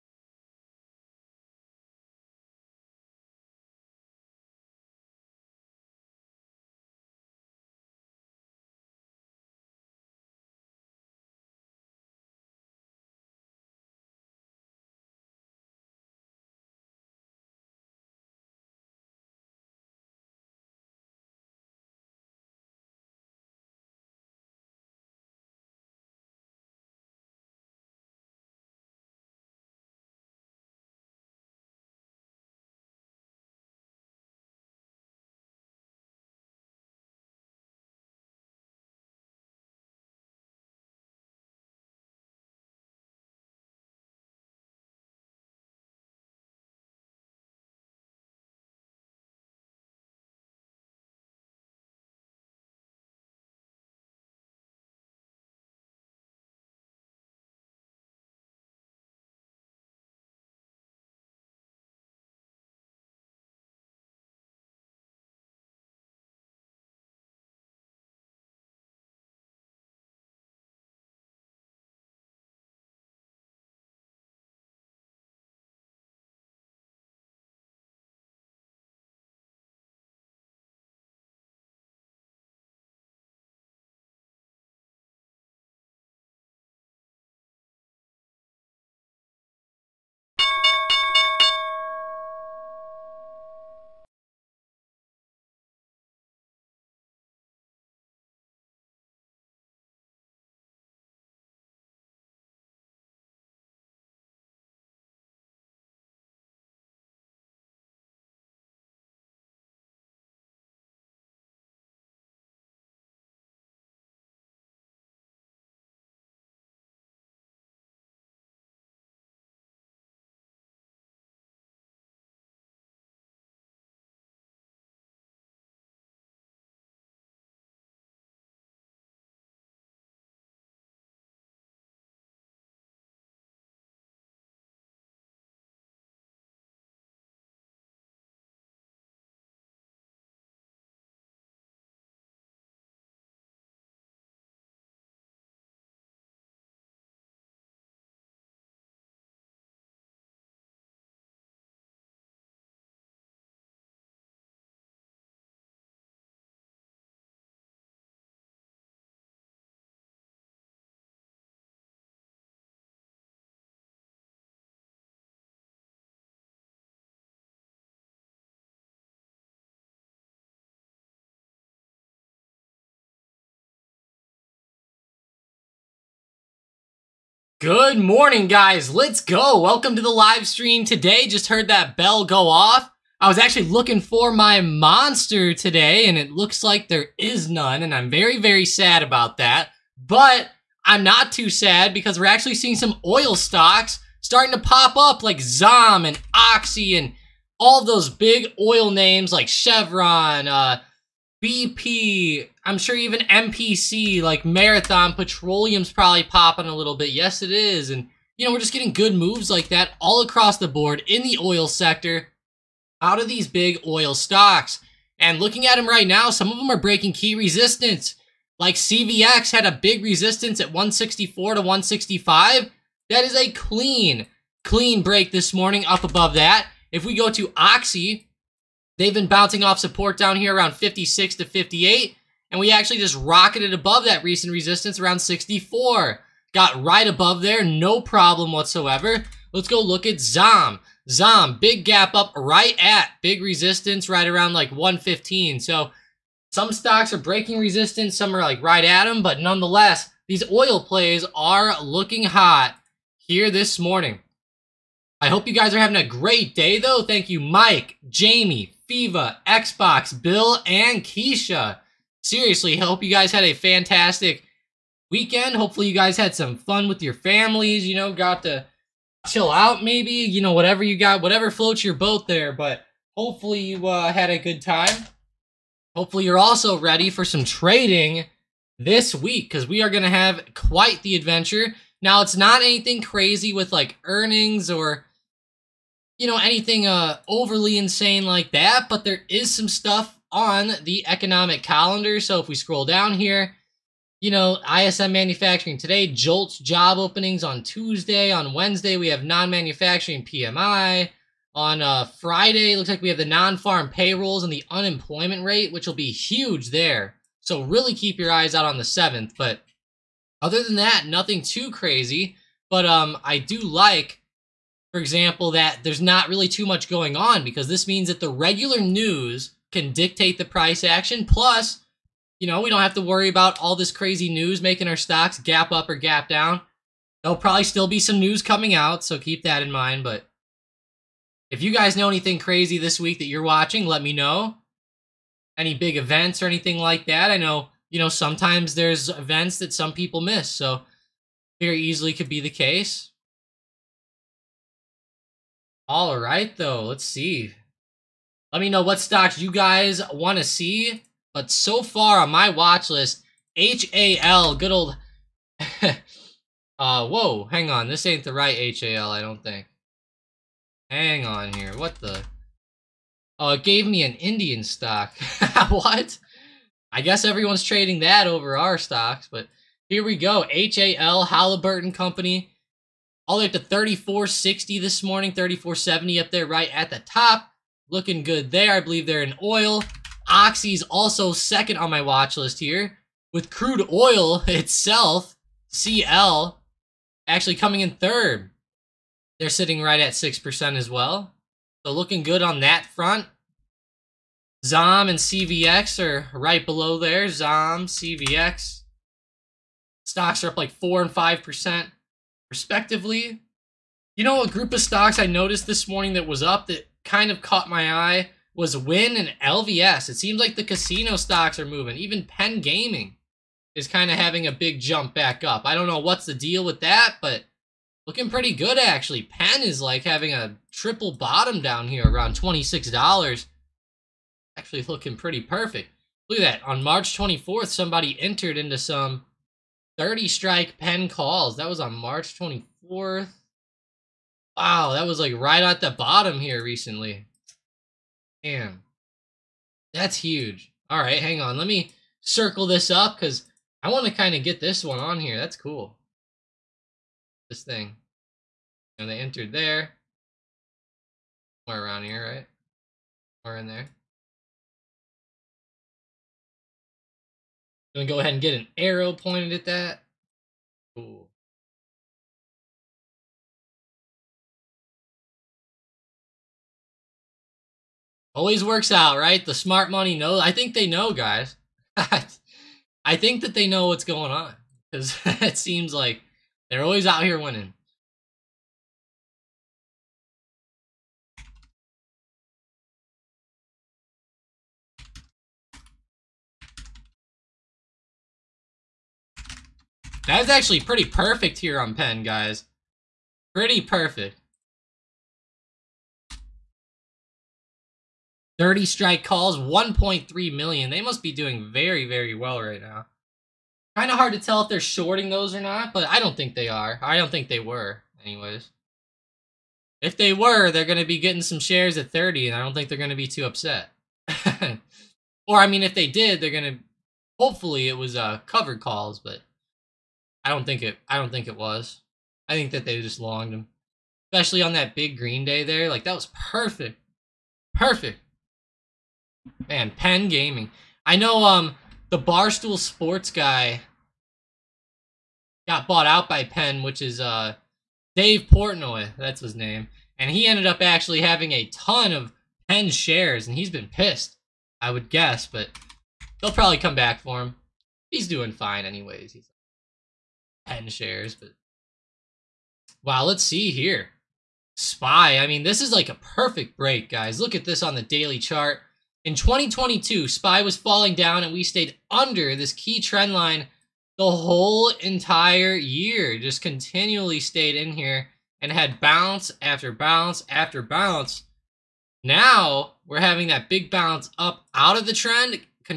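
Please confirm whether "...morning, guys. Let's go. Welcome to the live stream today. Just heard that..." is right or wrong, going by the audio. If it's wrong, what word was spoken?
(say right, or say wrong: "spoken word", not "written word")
right.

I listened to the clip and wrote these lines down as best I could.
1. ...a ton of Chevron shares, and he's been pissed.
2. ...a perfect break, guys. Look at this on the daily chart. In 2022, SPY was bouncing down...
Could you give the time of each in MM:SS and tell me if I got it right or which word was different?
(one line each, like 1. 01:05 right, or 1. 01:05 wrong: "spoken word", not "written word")
1. 09:01 wrong: "Penn", not "Chevron"
2. 09:16 wrong: "falling", not "bouncing".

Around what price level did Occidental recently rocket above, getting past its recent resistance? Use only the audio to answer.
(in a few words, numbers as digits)
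64.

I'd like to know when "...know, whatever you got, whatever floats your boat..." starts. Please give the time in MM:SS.
04:30.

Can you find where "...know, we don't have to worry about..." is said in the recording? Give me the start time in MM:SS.
05:22.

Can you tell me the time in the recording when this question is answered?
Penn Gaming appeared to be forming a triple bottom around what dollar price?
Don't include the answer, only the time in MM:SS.
07:02.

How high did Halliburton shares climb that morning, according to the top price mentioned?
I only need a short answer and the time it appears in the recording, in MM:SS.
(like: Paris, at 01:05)
34.70, at 06:15.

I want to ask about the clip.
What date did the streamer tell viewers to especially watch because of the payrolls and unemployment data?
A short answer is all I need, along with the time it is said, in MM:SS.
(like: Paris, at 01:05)
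the 7th, at 05:08.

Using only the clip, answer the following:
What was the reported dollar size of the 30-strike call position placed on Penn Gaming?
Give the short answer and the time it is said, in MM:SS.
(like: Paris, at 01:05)
1.3 million, at 08:19.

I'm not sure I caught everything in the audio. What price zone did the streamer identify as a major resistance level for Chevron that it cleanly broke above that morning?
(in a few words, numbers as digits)
164 to 165.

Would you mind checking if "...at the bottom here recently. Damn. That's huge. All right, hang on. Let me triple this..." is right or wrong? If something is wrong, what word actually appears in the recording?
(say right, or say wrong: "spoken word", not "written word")
wrong: "circle", not "triple".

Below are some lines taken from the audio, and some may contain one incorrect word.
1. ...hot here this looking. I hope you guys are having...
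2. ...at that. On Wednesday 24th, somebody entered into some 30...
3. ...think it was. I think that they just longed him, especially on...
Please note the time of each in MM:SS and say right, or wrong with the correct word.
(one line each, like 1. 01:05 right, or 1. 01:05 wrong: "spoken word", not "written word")
1. 04:12 wrong: "morning", not "looking"
2. 07:06 wrong: "March", not "Wednesday"
3. 08:41 right.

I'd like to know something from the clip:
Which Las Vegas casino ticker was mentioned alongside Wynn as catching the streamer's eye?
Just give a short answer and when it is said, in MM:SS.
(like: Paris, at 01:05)
LVS, at 06:49.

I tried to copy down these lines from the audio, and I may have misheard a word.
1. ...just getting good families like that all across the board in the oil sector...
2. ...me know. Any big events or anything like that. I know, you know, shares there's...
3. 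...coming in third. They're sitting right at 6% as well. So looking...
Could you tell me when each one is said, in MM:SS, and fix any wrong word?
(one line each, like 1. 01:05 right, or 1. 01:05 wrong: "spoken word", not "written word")
1. 03:28 wrong: "moves", not "families"
2. 05:34 wrong: "sometimes", not "shares"
3. 06:27 right.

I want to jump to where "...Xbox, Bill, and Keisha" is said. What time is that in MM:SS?
04:19.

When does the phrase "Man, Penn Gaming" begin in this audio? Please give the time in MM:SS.
08:49.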